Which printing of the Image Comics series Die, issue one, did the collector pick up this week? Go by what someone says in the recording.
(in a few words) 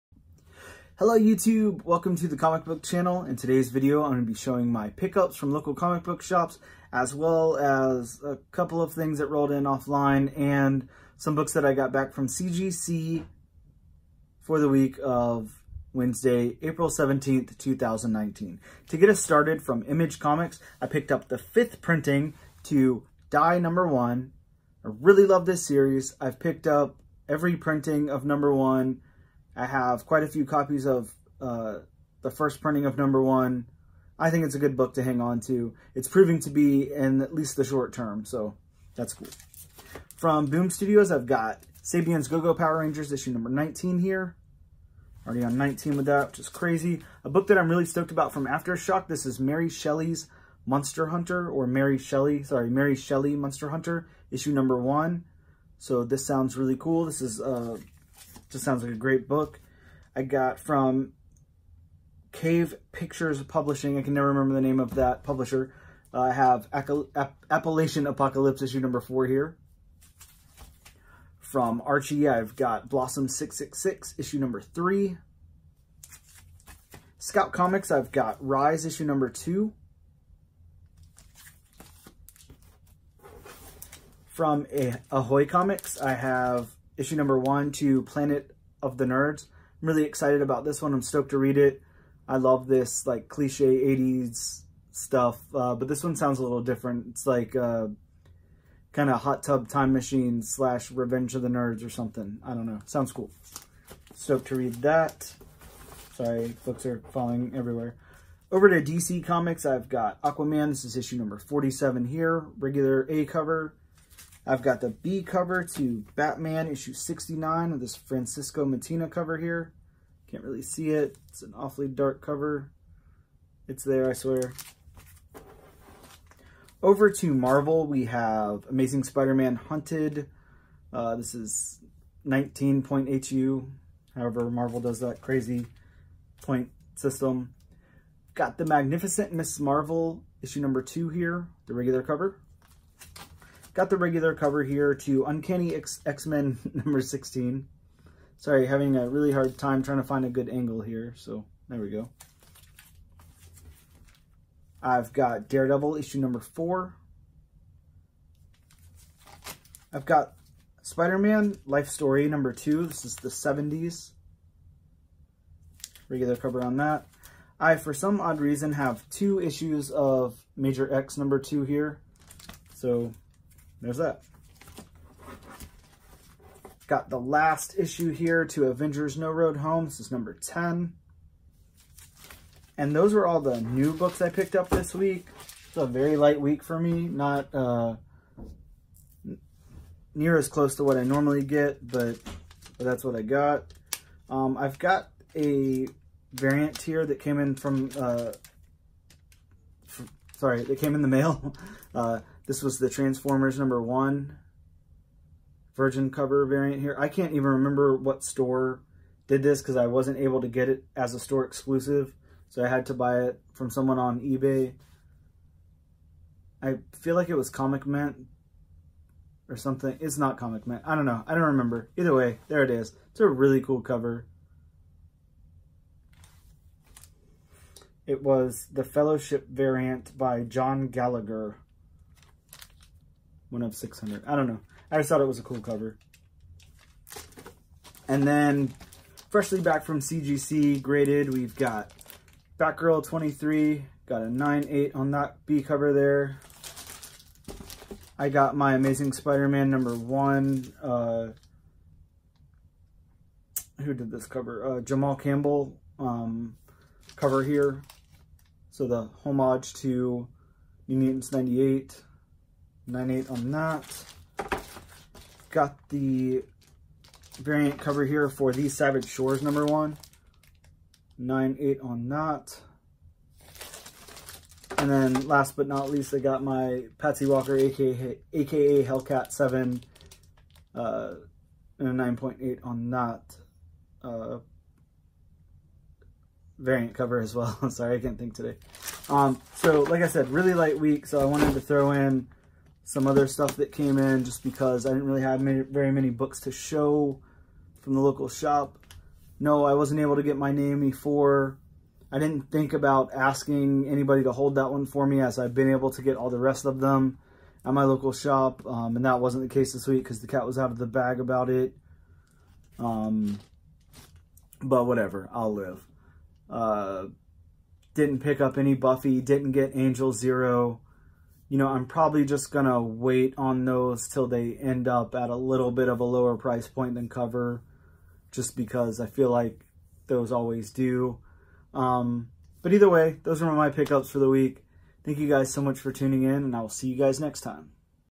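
Fifth printing.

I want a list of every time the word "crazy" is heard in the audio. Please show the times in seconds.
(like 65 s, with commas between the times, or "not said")
46 s, 135 s.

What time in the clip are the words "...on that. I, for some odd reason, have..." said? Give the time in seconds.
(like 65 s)
166 s.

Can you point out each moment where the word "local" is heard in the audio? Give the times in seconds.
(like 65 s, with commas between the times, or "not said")
5 s, 297 s, 307 s.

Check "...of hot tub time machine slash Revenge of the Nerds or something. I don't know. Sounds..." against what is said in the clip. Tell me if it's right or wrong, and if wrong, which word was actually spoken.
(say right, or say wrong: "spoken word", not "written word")
right.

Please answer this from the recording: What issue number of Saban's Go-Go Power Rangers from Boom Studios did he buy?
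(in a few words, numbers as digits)
19.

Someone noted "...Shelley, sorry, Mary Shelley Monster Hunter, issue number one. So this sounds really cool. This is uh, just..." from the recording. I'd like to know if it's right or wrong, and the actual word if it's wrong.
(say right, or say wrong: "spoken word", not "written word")
right.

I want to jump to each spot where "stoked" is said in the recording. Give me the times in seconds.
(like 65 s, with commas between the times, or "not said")
47 s, 91 s, 104 s.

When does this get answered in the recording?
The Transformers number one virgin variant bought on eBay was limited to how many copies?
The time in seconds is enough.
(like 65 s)
233 s.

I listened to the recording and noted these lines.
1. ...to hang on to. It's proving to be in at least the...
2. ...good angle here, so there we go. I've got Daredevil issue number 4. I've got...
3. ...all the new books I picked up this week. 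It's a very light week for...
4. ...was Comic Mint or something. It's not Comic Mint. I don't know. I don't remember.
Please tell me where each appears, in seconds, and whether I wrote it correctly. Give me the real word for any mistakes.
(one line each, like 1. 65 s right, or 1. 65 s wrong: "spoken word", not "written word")
1. 34 s right
2. 150 s right
3. 183 s right
4. 217 s right.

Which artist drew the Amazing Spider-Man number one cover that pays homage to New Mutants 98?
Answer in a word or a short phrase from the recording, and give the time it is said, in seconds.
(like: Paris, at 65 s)
Jamal Campbell, at 254 s.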